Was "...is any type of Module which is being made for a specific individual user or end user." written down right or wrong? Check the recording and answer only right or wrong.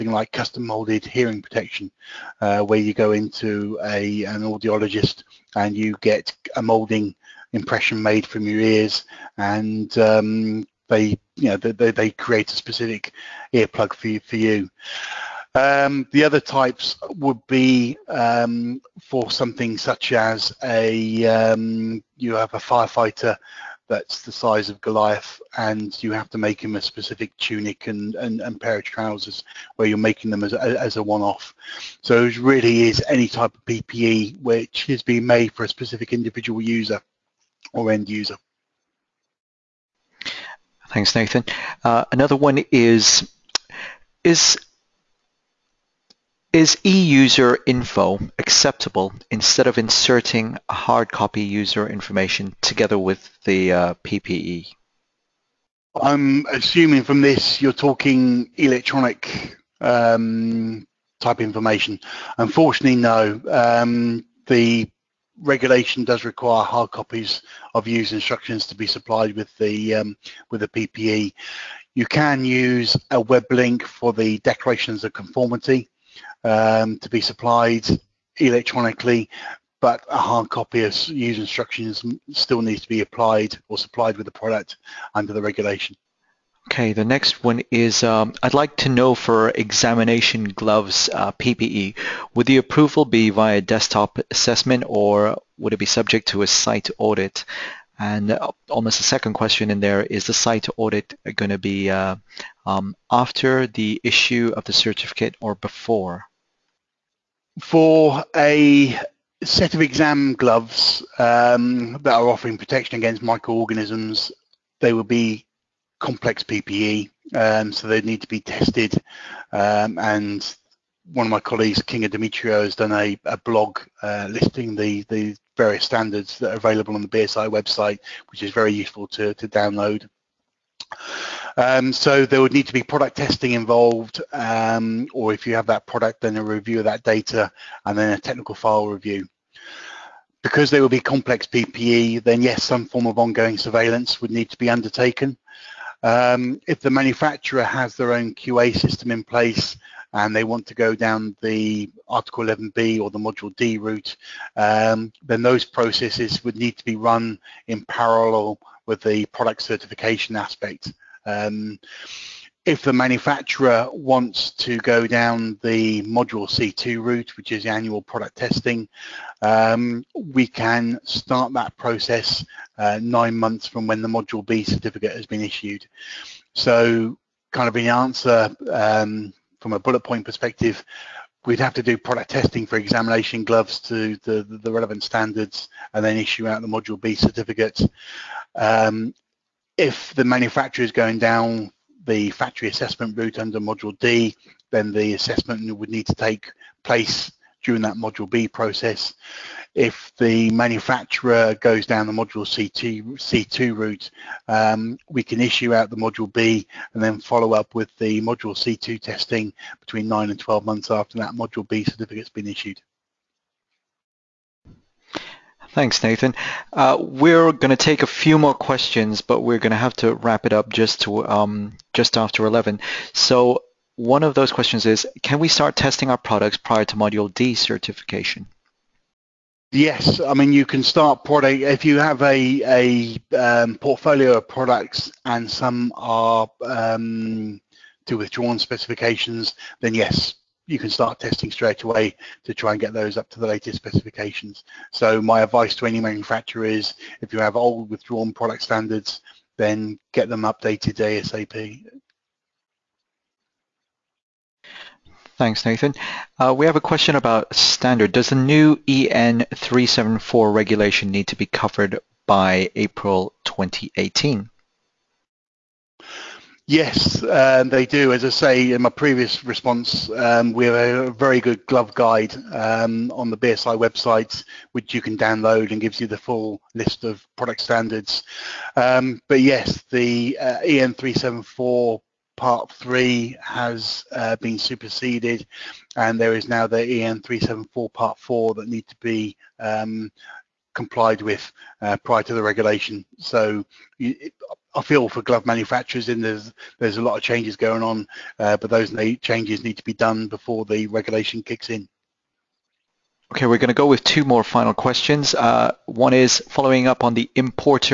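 wrong.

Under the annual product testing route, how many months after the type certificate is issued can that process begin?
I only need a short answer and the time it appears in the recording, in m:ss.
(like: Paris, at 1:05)
9, at 2:53.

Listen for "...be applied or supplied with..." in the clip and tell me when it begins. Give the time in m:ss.
1:22.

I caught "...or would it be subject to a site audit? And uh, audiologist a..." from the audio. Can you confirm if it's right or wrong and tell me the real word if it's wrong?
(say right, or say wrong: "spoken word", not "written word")
wrong: "almost", not "audiologist".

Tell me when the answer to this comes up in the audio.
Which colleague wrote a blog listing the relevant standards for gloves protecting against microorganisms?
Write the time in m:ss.
2:01.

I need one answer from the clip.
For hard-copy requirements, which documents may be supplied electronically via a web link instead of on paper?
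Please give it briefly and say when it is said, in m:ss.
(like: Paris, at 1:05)
Declarations of conformity, at 1:14.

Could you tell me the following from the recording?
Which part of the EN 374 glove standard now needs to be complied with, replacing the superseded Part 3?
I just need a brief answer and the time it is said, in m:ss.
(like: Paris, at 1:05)
Part 4, at 4:47.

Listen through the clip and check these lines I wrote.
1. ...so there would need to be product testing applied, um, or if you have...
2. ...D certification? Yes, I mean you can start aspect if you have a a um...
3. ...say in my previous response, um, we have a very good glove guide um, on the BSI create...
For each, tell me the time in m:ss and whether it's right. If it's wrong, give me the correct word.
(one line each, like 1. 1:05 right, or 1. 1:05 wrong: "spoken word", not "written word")
1. 2:11 wrong: "involved", not "applied"
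2. 3:47 wrong: "product", not "aspect"
3. 4:28 wrong: "website", not "create".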